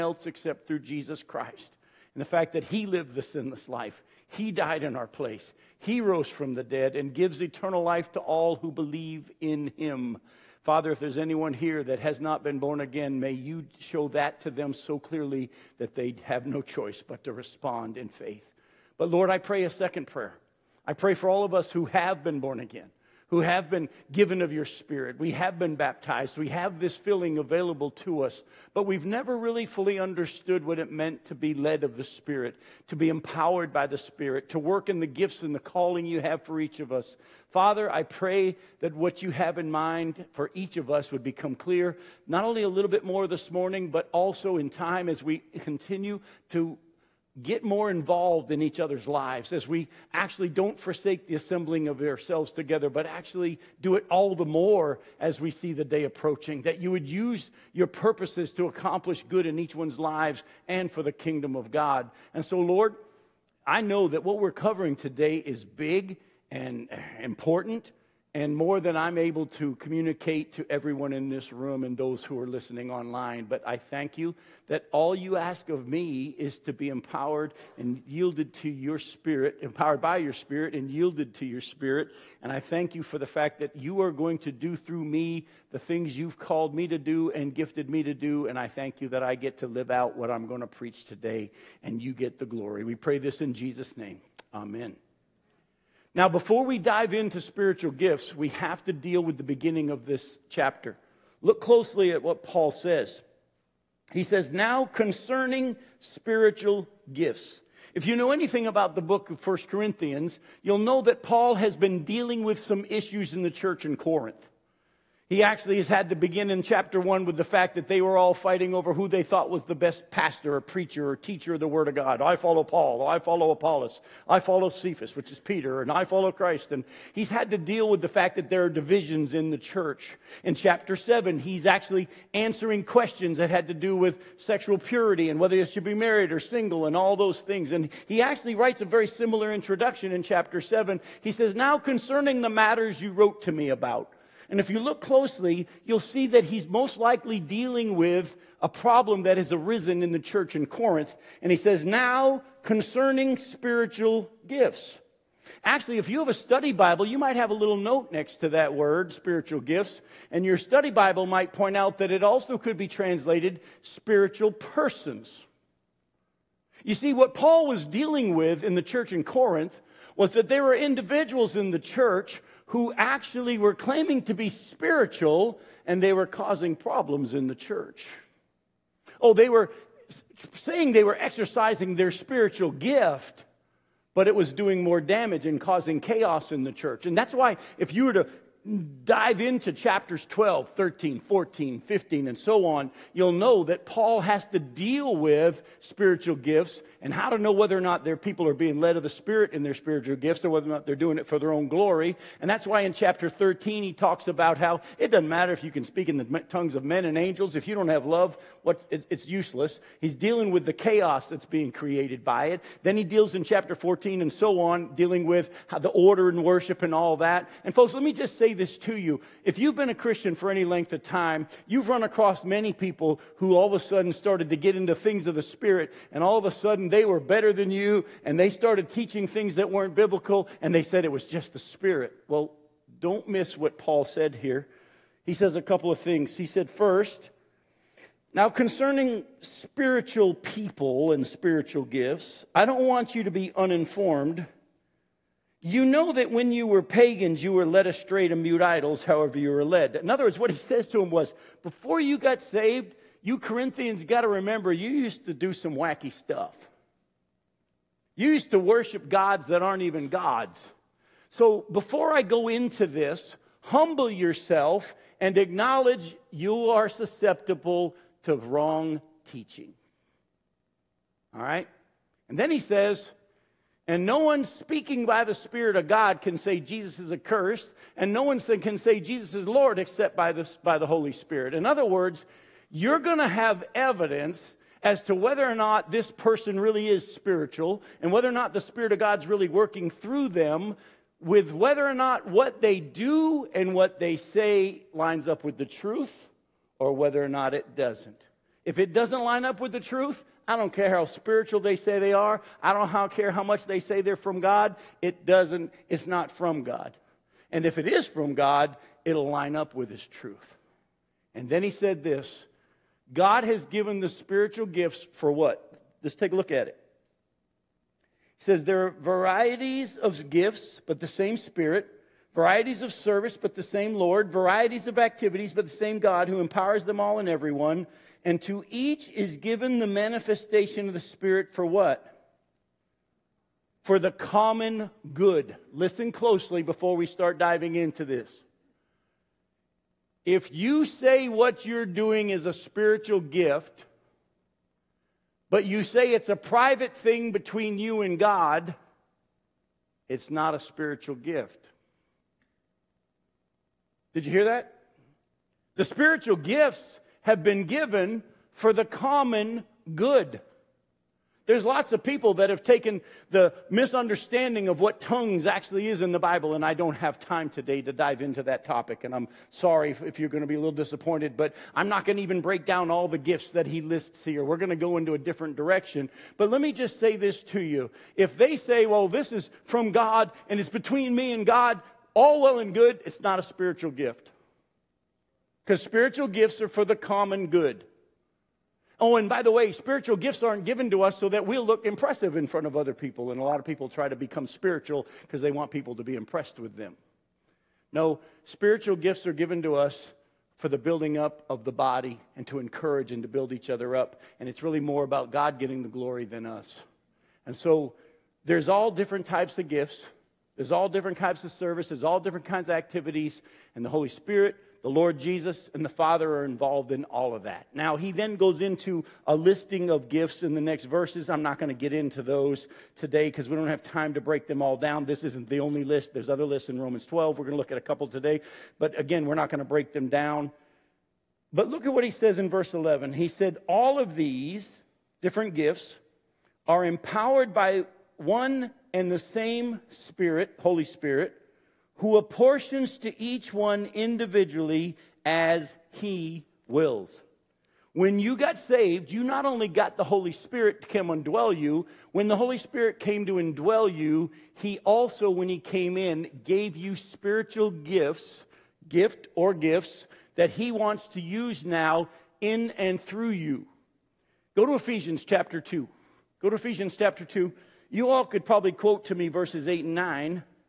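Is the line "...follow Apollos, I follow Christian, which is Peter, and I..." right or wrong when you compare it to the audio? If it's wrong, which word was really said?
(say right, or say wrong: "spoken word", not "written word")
wrong: "Cephas", not "Christian".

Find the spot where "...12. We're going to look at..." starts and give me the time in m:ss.
7:07.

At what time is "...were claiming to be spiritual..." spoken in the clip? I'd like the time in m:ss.
2:53.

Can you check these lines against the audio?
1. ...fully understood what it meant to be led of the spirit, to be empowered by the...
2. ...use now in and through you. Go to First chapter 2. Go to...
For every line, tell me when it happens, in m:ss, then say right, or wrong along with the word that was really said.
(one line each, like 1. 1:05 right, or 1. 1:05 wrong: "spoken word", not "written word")
1. 0:29 right
2. 7:41 wrong: "Ephesians", not "First".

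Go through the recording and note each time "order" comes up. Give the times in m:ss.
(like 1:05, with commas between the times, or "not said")
3:35.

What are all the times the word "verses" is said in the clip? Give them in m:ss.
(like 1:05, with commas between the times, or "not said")
7:00, 7:12, 7:49.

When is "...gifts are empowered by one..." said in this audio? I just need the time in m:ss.
7:15.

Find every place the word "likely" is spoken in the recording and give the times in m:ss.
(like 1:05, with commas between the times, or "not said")
2:26.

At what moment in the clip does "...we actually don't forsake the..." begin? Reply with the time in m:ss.
0:49.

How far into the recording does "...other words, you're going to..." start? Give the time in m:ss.
4:41.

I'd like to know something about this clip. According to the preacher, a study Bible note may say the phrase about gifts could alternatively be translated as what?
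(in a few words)
spiritual persons.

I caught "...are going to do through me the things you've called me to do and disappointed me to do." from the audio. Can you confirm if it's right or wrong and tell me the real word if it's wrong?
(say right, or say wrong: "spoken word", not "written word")
wrong: "gifted", not "disappointed".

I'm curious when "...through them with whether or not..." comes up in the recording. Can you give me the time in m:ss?
4:49.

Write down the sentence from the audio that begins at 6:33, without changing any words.
And a lot of people try to become spiritual because they want people to be impressed with them.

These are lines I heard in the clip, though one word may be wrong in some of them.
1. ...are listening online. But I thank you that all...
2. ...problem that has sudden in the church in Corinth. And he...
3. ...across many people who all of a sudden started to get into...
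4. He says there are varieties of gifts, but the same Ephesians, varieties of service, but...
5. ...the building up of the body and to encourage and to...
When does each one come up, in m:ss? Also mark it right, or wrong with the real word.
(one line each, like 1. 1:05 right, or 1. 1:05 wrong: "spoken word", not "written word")
1. 1:12 right
2. 2:28 wrong: "arisen", not "sudden"
3. 3:42 right
4. 5:18 wrong: "Spirit", not "Ephesians"
5. 6:40 right.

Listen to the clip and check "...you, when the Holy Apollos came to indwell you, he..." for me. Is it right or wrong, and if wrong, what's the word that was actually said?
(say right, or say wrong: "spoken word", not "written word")
wrong: "Spirit", not "Apollos".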